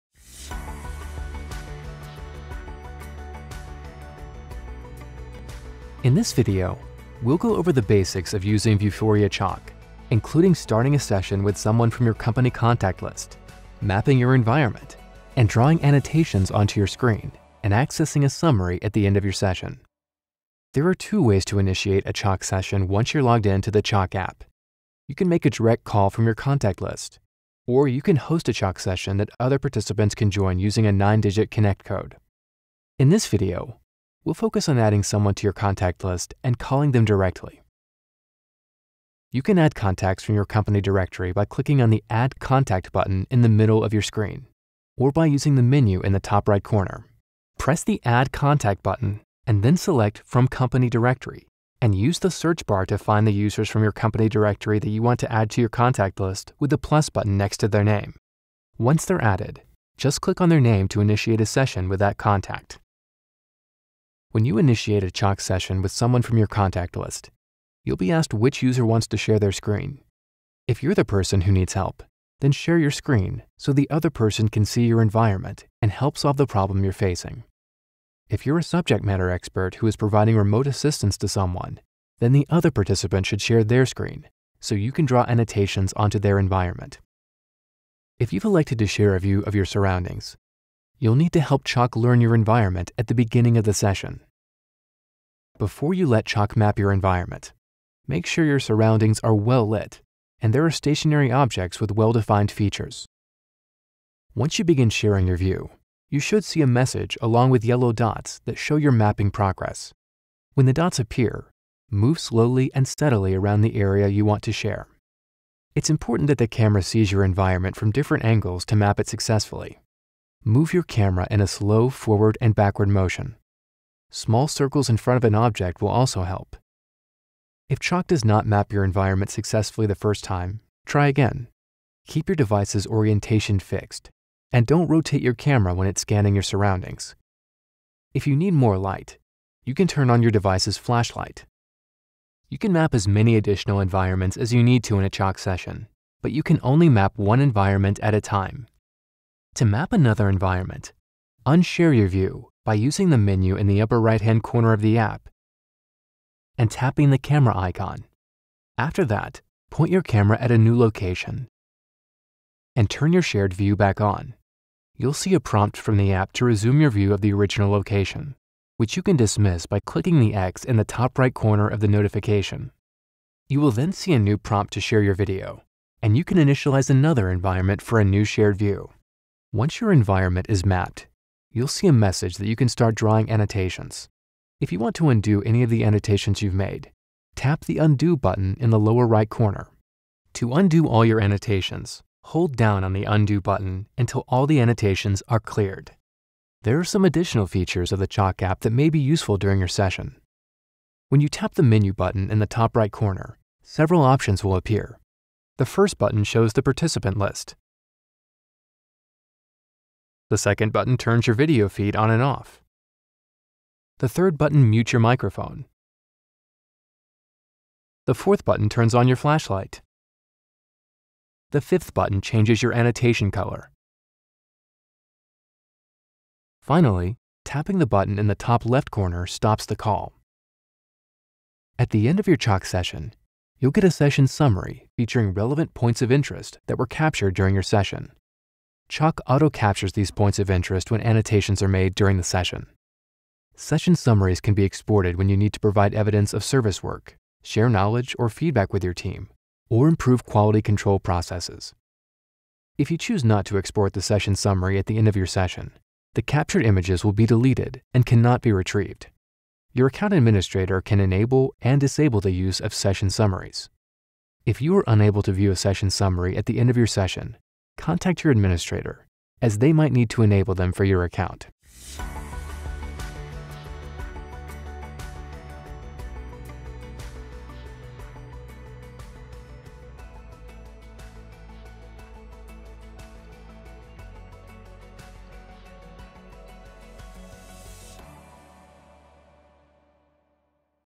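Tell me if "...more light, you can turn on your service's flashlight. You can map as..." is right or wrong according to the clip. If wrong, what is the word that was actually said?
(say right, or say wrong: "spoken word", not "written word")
wrong: "device", not "service".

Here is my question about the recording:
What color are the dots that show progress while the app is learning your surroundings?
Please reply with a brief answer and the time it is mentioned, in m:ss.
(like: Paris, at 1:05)
Yellow, at 1:47.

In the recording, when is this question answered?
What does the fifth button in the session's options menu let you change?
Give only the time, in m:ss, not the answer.
3:42.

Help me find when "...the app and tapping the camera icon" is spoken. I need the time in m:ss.
2:34.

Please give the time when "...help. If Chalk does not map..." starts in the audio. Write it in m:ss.
2:06.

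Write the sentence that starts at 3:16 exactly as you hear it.
There are some additional features of the Chalk app that may be useful during your session.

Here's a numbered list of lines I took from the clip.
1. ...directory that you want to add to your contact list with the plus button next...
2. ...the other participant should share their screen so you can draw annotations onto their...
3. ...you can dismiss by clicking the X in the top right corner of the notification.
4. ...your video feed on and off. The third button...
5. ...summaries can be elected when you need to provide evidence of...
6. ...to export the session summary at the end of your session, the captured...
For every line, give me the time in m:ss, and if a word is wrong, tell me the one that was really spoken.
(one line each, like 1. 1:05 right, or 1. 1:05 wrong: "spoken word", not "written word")
1. 0:54 right
2. 1:22 right
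3. 2:48 right
4. 3:31 right
5. 4:03 wrong: "exported", not "elected"
6. 4:13 right.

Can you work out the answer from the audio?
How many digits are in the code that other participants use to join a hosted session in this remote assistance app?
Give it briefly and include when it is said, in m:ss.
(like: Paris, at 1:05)
9, at 0:30.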